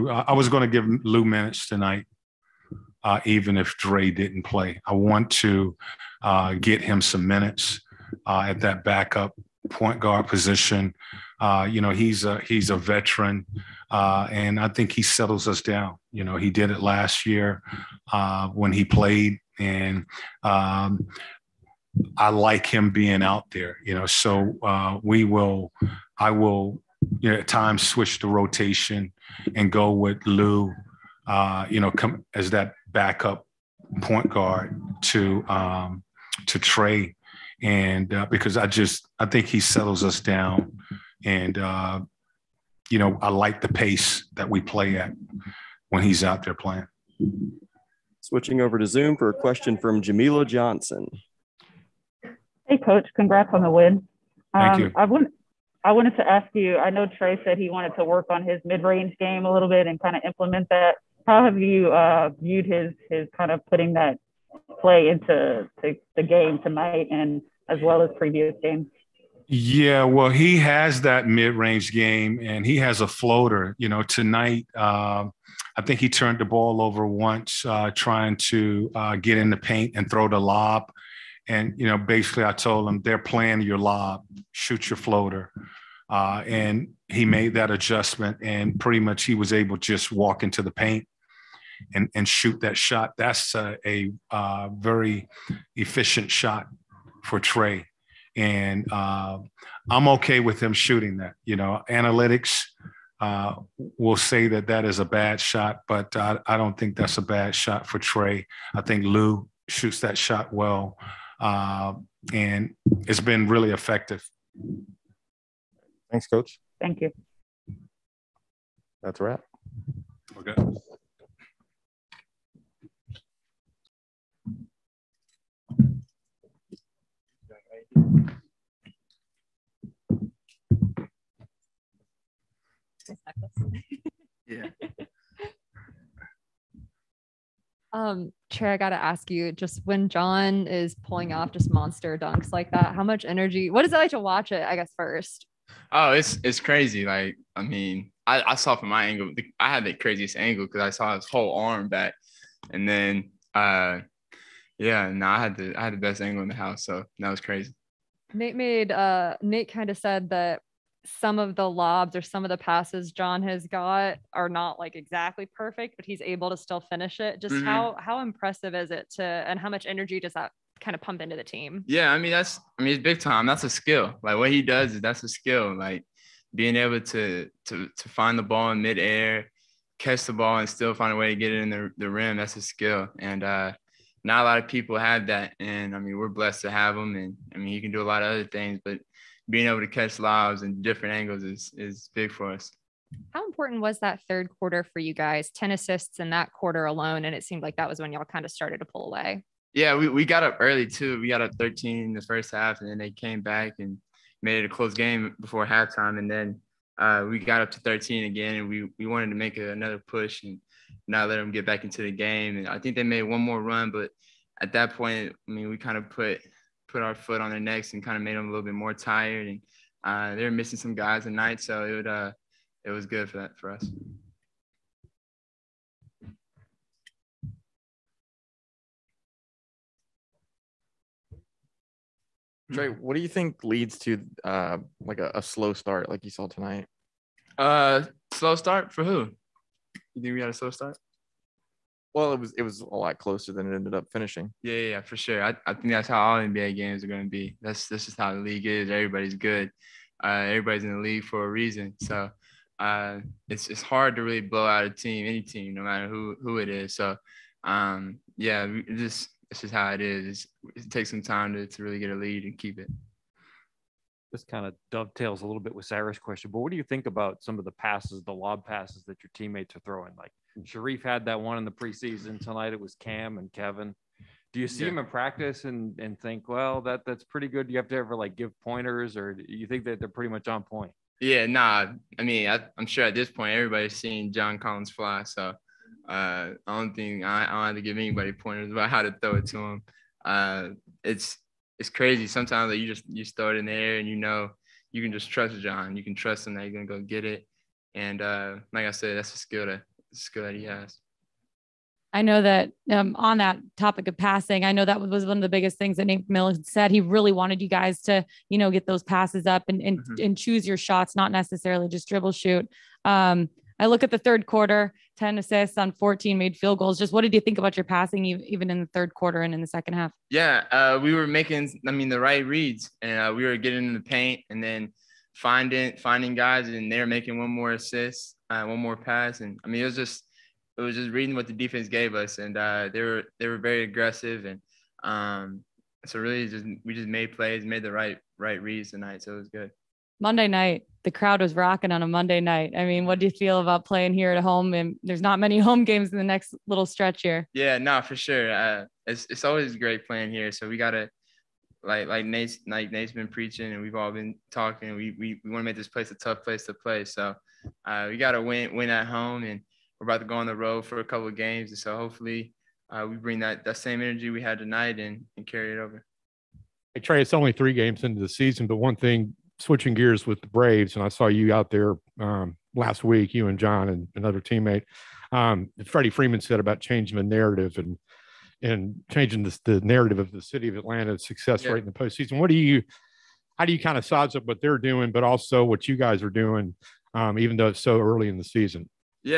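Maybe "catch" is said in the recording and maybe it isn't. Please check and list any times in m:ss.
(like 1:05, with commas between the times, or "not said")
2:59, 3:09.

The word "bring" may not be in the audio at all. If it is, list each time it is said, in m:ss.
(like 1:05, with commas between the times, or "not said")
6:03.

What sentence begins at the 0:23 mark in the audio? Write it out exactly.
You know, so uh, we will, I will, you know, at times switch the rotation and go with Lou.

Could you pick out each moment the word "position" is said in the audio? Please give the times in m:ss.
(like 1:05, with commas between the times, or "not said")
0:10.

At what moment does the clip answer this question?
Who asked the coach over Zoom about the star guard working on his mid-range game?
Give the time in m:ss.
0:50.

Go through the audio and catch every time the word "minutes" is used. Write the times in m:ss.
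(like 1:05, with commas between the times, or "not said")
0:01, 0:07.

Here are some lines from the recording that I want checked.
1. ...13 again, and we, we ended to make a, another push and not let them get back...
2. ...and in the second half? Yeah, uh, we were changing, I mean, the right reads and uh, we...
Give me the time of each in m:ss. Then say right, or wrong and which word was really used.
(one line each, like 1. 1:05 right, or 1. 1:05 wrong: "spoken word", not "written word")
1. 3:27 wrong: "wanted", not "ended"
2. 5:19 wrong: "making", not "changing".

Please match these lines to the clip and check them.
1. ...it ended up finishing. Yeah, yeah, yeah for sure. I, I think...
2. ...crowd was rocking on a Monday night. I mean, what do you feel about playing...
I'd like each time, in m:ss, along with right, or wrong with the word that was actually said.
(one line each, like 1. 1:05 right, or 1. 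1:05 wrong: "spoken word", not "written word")
1. 4:03 right
2. 5:41 right.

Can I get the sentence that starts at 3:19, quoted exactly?
Yeah, we, we got up early too.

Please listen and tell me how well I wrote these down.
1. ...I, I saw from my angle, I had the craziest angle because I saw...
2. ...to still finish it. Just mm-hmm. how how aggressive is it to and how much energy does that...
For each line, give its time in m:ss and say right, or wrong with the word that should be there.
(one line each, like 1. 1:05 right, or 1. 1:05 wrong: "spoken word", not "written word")
1. 2:28 right
2. 2:46 wrong: "impressive", not "aggressive".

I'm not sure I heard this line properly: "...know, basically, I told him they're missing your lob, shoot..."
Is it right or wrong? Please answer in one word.
wrong.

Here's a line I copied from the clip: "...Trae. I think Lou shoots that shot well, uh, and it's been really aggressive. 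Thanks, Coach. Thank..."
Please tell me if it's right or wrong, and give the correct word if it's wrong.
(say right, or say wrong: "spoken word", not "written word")
wrong: "effective", not "aggressive".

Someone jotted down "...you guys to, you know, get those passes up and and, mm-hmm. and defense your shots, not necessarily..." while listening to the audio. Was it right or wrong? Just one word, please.
wrong.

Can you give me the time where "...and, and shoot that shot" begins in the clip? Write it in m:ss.
1:31.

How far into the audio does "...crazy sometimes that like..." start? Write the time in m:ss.
4:51.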